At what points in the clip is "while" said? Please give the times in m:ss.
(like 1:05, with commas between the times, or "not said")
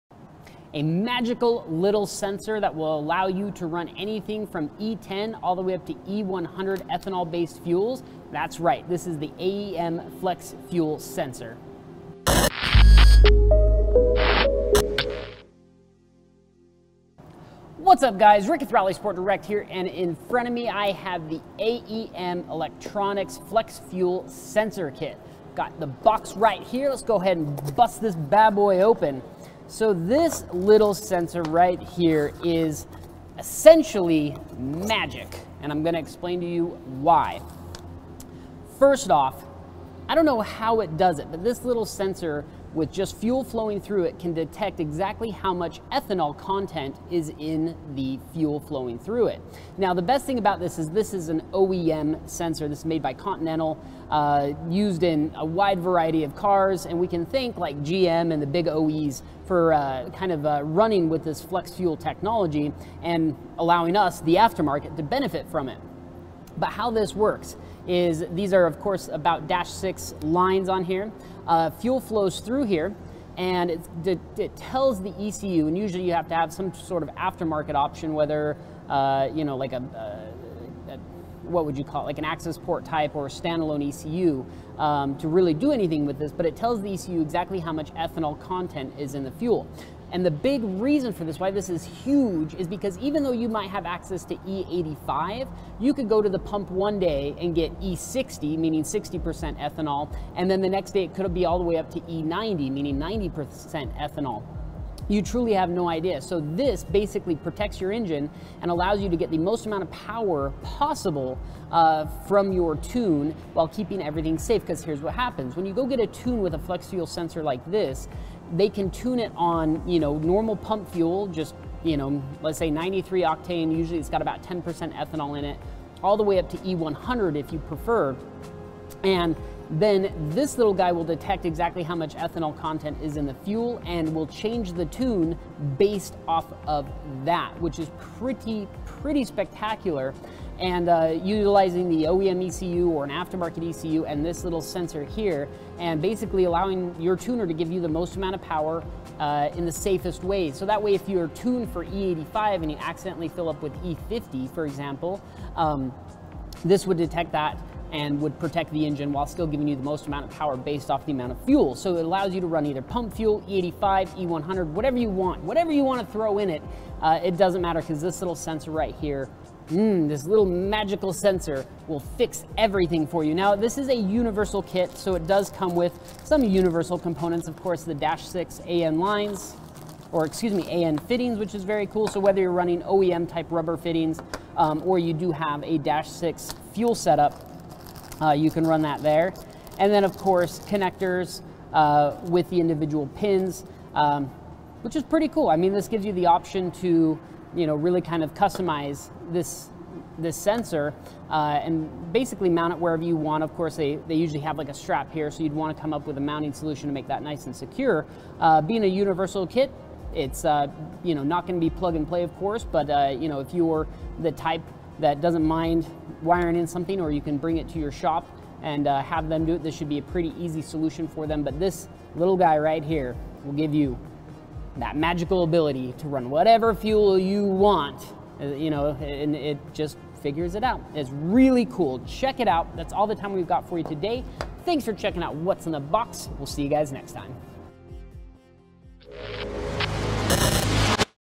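1:53, 2:39.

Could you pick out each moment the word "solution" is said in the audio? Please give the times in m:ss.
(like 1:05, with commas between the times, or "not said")
3:26, 3:40.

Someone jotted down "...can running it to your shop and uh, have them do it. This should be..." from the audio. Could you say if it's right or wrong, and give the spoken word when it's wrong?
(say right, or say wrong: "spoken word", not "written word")
wrong: "bring", not "running".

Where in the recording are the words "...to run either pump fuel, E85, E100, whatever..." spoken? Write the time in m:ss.
2:42.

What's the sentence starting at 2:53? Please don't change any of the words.
Now, this is a universal kit, so it does come with some universal components.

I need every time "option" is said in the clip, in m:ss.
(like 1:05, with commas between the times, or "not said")
1:17, 3:16.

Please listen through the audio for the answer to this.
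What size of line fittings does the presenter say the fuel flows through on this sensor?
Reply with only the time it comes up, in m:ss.
1:09.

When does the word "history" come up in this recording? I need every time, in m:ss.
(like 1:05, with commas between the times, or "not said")
not said.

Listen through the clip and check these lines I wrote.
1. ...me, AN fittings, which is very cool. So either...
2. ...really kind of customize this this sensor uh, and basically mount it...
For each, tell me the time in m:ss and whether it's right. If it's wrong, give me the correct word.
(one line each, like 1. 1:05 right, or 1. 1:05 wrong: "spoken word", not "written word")
1. 3:00 wrong: "whether", not "either"
2. 3:17 right.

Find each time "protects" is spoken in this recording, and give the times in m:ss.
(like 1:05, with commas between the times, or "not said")
1:47, 2:38.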